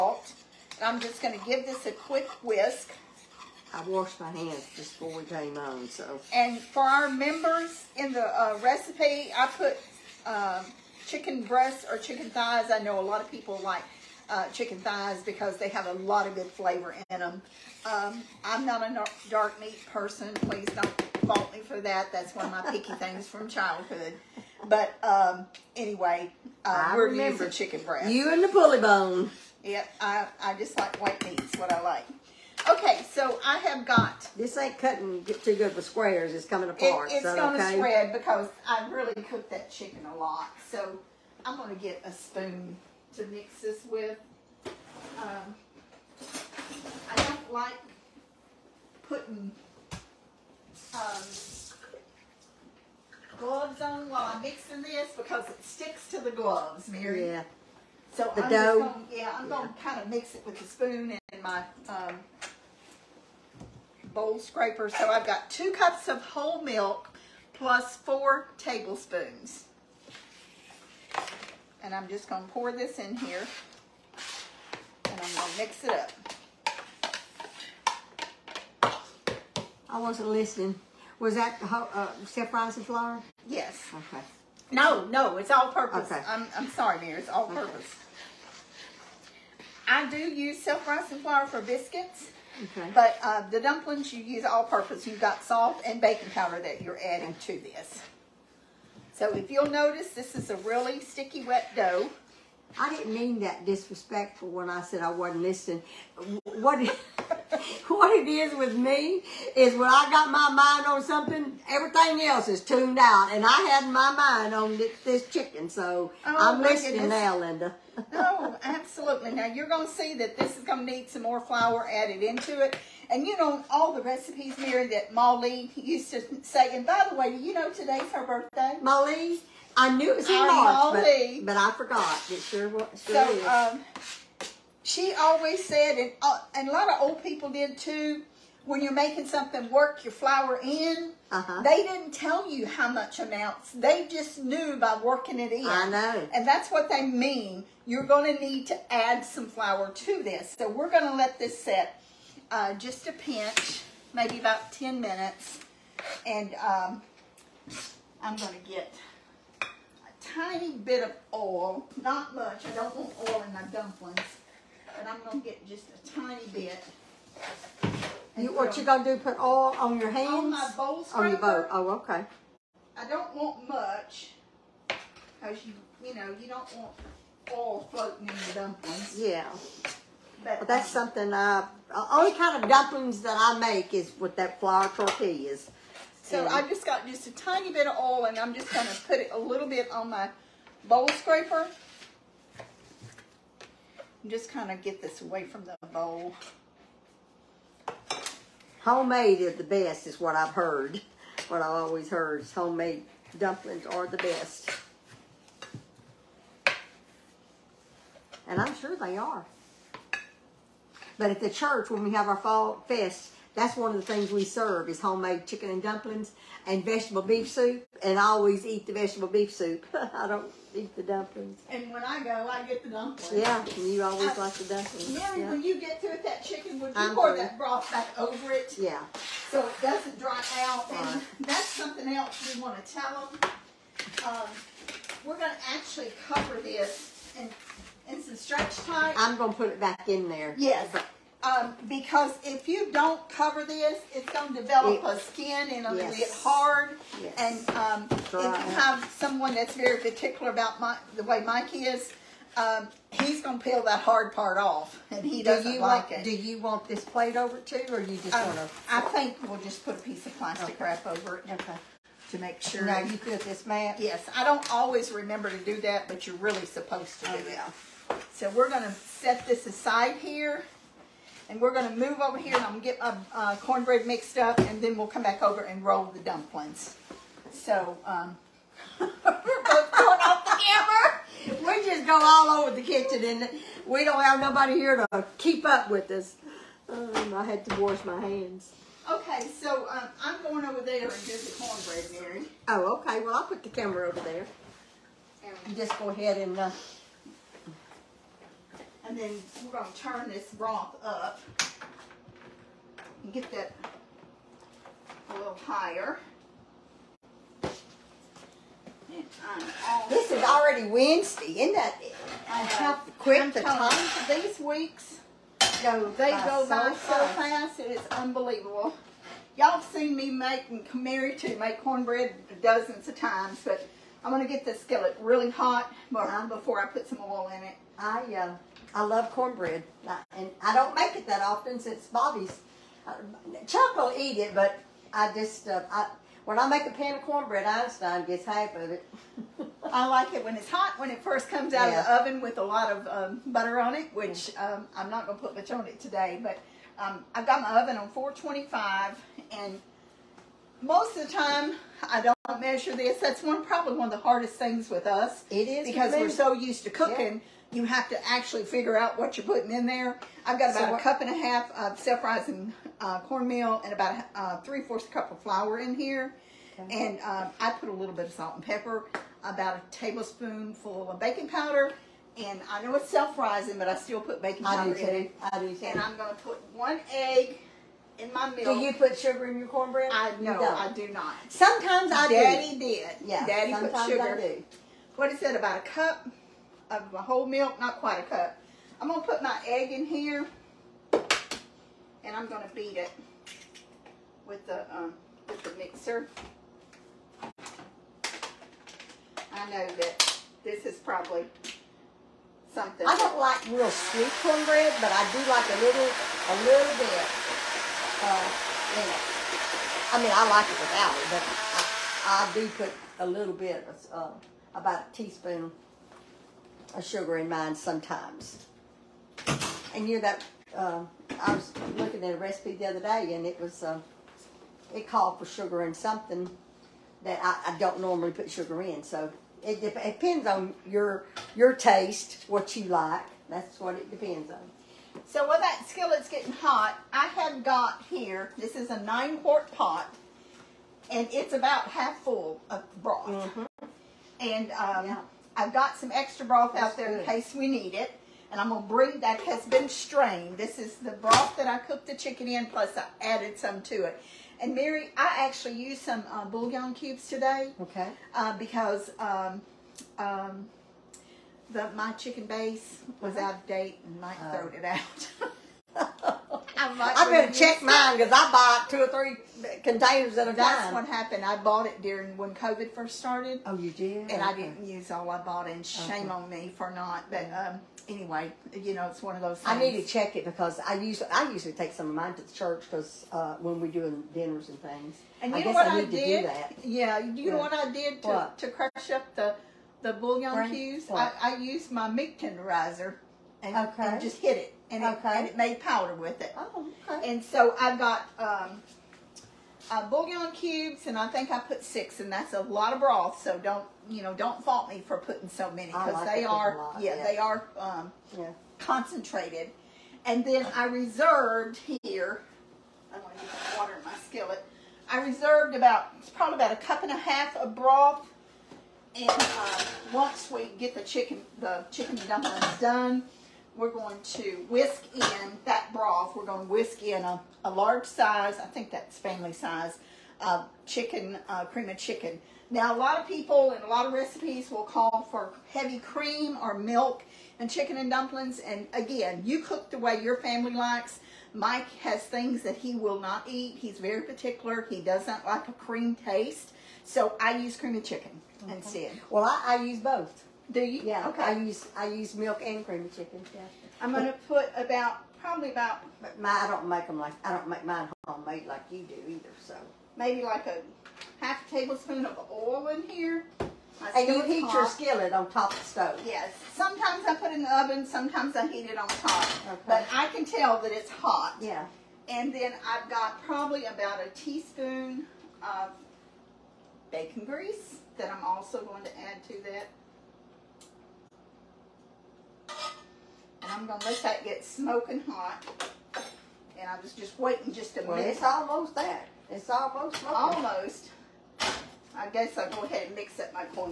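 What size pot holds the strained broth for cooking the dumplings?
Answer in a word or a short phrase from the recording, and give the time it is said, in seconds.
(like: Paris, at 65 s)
9 quart, at 439 s.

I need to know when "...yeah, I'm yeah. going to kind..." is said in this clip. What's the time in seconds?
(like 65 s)
59 s.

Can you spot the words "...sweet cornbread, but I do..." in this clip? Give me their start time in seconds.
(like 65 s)
403 s.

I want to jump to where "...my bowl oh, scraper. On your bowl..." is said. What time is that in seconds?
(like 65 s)
170 s.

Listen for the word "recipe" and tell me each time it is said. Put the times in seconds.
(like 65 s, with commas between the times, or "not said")
8 s, 124 s, 422 s, 534 s.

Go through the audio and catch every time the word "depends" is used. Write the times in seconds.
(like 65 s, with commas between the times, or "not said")
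429 s, 434 s.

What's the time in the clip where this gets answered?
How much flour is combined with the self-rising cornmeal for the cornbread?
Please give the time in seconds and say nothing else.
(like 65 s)
364 s.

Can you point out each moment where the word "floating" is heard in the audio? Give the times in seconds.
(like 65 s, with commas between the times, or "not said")
177 s.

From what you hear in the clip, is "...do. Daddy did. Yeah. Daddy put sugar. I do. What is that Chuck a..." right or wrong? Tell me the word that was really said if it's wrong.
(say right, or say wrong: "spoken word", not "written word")
wrong: "About", not "Chuck".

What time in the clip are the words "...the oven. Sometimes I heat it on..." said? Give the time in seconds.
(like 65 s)
567 s.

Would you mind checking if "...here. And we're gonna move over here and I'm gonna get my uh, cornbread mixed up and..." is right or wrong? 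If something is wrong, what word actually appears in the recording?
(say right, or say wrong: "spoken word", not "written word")
right.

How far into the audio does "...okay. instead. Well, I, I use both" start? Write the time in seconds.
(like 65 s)
548 s.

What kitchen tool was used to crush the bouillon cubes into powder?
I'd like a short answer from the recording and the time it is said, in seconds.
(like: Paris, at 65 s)
meat tenderizer, at 492 s.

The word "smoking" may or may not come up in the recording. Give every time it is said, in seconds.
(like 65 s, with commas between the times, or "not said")
584 s, 590 s.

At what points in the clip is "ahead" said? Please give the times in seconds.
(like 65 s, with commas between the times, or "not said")
296 s, 592 s.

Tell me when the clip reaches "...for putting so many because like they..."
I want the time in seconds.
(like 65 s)
505 s.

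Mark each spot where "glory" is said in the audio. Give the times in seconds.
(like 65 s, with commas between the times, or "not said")
not said.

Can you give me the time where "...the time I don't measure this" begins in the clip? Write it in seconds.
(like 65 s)
351 s.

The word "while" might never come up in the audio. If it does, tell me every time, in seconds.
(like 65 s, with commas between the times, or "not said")
54 s, 435 s.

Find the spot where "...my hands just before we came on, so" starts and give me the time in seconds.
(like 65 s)
4 s.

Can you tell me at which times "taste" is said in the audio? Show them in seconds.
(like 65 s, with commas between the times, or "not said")
431 s, 546 s.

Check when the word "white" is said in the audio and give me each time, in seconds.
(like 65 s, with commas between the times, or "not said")
31 s.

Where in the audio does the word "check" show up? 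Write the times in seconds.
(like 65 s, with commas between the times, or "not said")
467 s, 480 s.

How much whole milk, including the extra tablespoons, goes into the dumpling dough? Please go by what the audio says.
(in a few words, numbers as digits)
2 cups plus 4 tablespoons.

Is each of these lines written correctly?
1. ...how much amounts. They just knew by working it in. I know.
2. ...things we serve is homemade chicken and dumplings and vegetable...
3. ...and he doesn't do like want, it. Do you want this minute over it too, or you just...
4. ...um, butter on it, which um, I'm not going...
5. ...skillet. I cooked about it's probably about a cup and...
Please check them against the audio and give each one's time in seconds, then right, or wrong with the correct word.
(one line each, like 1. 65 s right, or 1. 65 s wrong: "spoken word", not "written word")
1. 142 s right
2. 214 s right
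3. 255 s wrong: "plate", not "minute"
4. 343 s right
5. 514 s wrong: "reserved", not "cooked".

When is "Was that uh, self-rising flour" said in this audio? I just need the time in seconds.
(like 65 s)
81 s.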